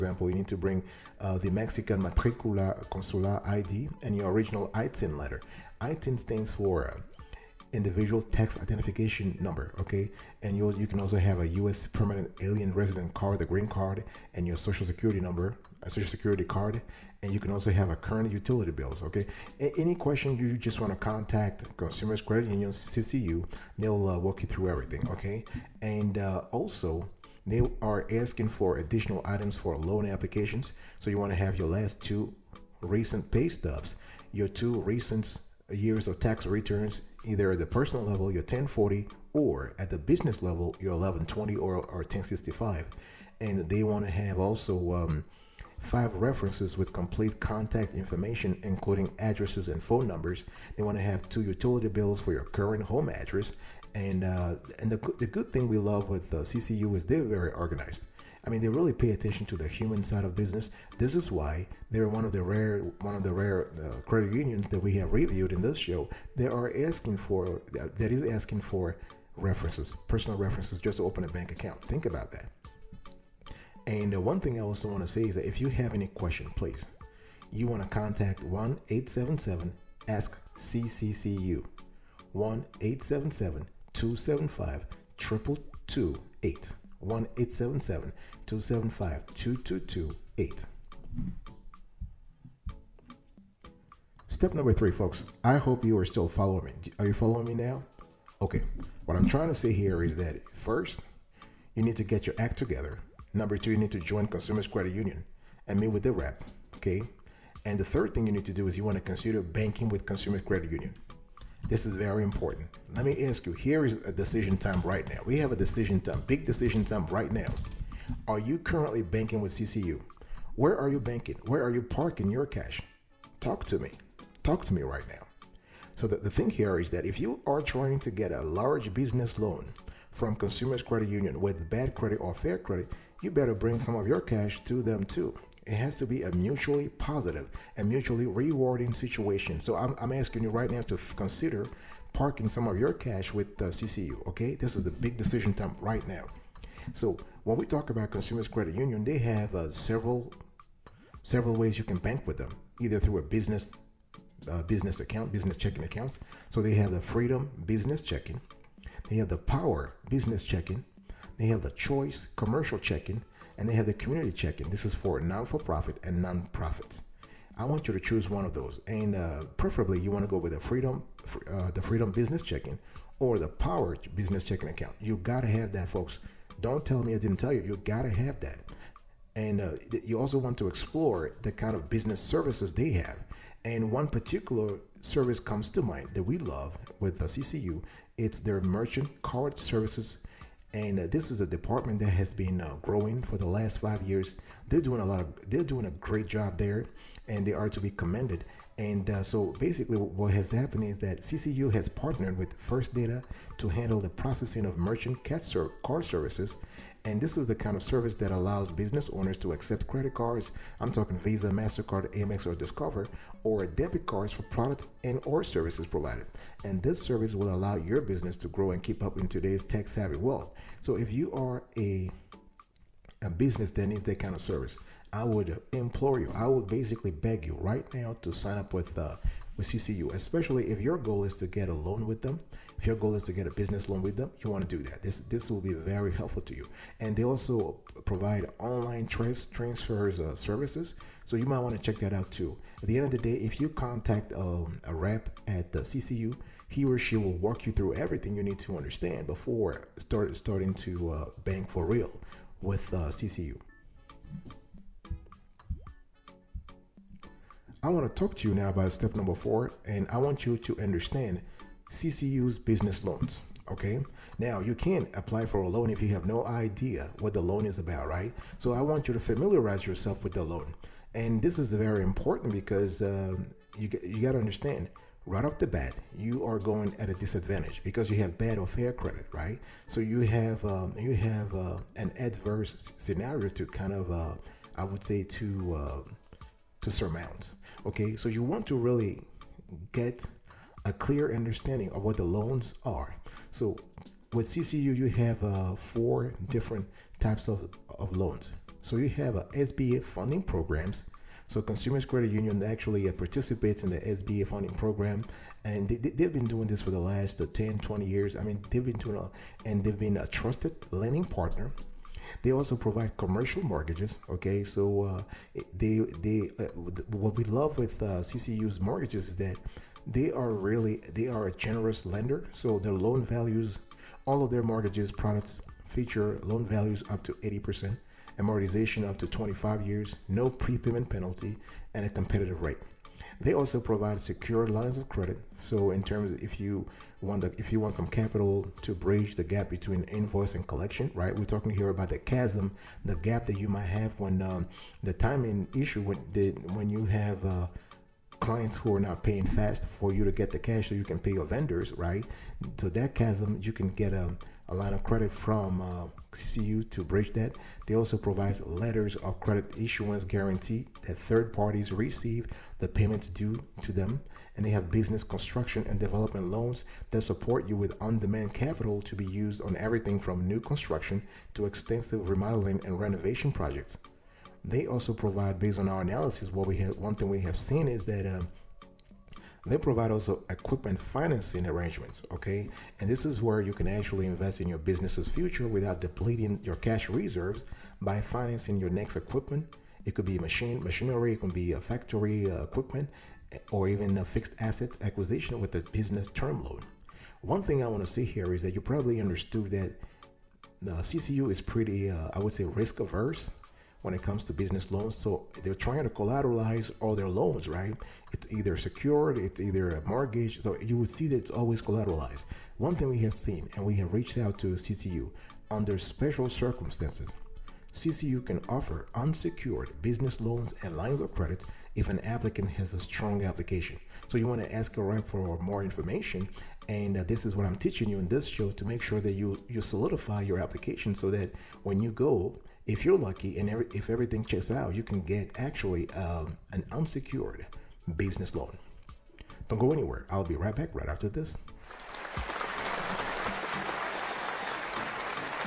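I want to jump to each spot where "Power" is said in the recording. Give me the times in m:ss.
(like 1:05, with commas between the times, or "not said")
2:39, 2:53.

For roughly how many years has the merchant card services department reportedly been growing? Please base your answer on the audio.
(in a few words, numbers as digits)
5 years.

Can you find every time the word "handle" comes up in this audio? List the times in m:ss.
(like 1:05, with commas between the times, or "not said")
3:23.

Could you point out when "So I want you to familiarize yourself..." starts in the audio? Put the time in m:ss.
4:28.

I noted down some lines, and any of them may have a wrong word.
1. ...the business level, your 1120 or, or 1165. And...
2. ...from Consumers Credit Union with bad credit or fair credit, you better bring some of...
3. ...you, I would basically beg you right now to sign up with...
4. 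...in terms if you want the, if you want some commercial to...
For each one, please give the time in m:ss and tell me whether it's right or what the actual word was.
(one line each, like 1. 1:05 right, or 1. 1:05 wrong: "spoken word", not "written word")
1. 0:39 wrong: "1065", not "1165"
2. 2:10 right
3. 3:46 right
4. 5:35 wrong: "capital", not "commercial".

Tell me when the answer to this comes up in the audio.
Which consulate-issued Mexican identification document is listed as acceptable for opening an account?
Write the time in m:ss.
0:01.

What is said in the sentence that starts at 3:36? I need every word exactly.
And this service will allow your business to grow and keep up in today's tech-savvy world.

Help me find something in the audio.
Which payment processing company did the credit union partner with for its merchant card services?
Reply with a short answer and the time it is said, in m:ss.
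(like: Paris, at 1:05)
First Data, at 3:22.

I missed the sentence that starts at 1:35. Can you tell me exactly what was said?
I hope you are still following me.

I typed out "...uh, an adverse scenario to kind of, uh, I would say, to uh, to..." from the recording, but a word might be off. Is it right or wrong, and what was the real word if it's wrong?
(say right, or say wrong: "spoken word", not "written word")
right.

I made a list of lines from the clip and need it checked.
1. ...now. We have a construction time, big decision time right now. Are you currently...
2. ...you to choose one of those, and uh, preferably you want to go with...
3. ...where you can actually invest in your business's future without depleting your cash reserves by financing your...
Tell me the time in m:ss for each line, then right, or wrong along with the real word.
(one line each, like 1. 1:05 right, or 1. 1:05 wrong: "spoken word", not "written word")
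1. 1:55 wrong: "decision", not "construction"
2. 2:47 right
3. 6:23 right.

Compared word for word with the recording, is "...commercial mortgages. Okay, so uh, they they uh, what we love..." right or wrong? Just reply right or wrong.
right.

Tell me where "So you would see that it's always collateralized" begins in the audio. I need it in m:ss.
6:50.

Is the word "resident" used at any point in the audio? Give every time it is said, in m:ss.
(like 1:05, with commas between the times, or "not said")
0:12.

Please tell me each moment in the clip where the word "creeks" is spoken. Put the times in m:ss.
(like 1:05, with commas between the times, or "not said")
not said.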